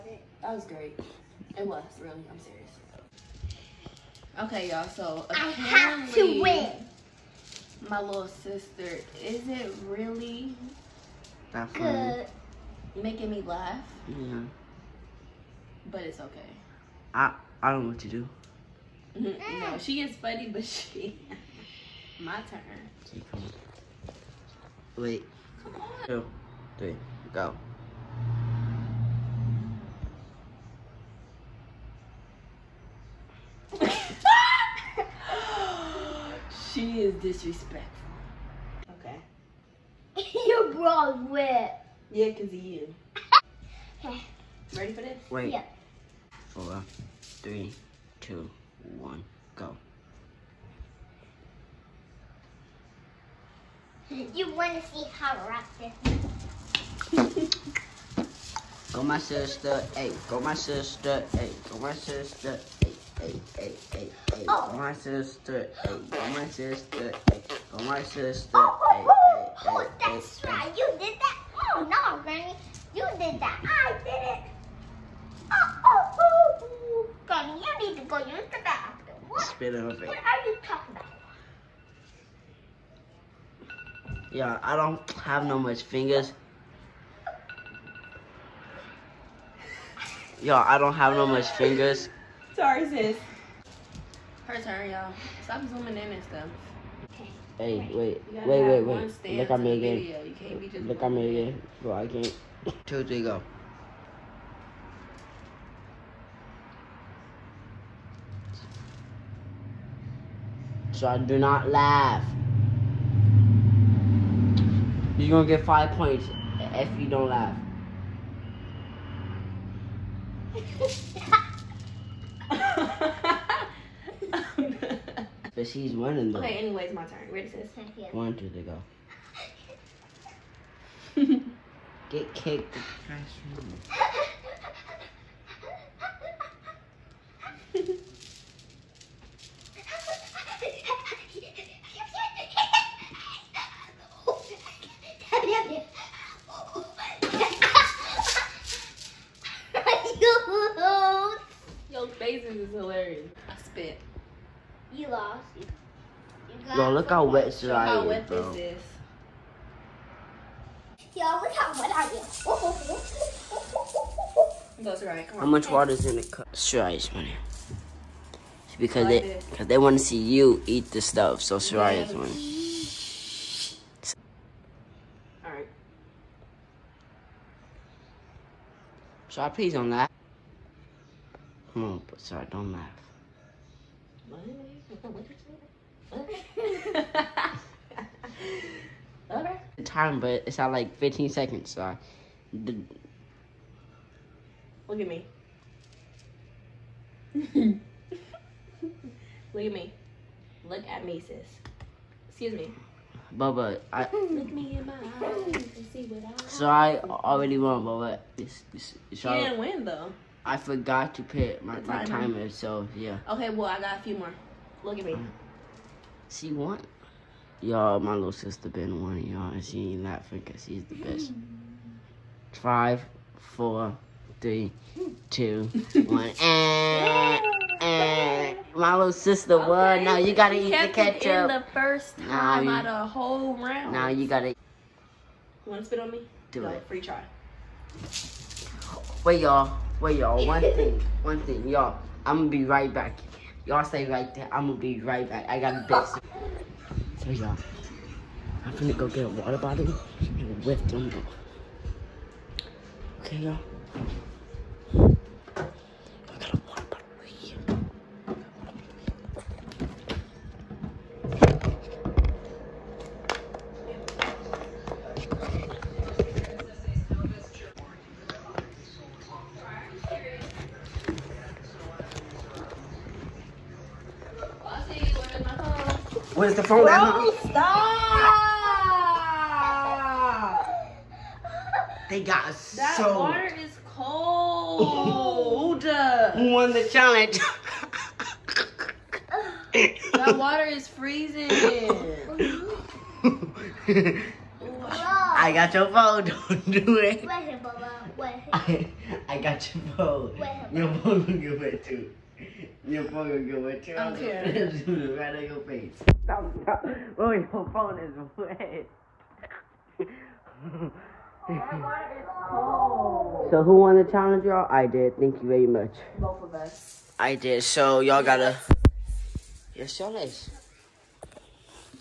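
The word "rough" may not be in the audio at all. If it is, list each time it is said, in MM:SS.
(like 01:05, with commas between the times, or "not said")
00:55.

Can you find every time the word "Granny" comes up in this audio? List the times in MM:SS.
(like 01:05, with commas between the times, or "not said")
01:12, 01:17.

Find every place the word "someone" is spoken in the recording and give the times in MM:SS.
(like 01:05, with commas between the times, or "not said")
not said.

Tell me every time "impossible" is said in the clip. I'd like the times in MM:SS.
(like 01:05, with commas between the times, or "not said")
not said.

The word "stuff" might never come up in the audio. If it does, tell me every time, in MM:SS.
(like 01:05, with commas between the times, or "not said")
01:36, 02:51.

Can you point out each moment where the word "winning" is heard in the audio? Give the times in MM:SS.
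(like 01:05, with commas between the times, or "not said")
02:05, 02:47, 02:52.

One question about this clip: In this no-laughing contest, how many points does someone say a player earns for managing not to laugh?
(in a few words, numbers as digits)
5.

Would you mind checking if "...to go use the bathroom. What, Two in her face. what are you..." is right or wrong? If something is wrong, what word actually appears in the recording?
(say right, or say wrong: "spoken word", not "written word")
wrong: "Spit", not "Two".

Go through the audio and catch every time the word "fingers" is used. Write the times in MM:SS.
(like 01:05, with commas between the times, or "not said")
01:25, 01:31.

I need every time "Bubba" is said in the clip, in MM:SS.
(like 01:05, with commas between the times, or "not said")
03:23, 03:27.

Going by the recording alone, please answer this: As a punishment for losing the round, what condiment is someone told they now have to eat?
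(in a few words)
ketchup.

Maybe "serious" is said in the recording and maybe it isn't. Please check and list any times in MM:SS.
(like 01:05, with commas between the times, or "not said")
00:02.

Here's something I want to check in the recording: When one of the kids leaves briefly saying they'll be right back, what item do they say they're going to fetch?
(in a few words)
water bottle.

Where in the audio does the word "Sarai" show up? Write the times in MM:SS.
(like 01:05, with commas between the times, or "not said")
02:46, 02:51.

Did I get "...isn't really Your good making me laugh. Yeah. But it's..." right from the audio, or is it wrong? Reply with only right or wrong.
wrong.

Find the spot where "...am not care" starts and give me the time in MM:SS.
05:03.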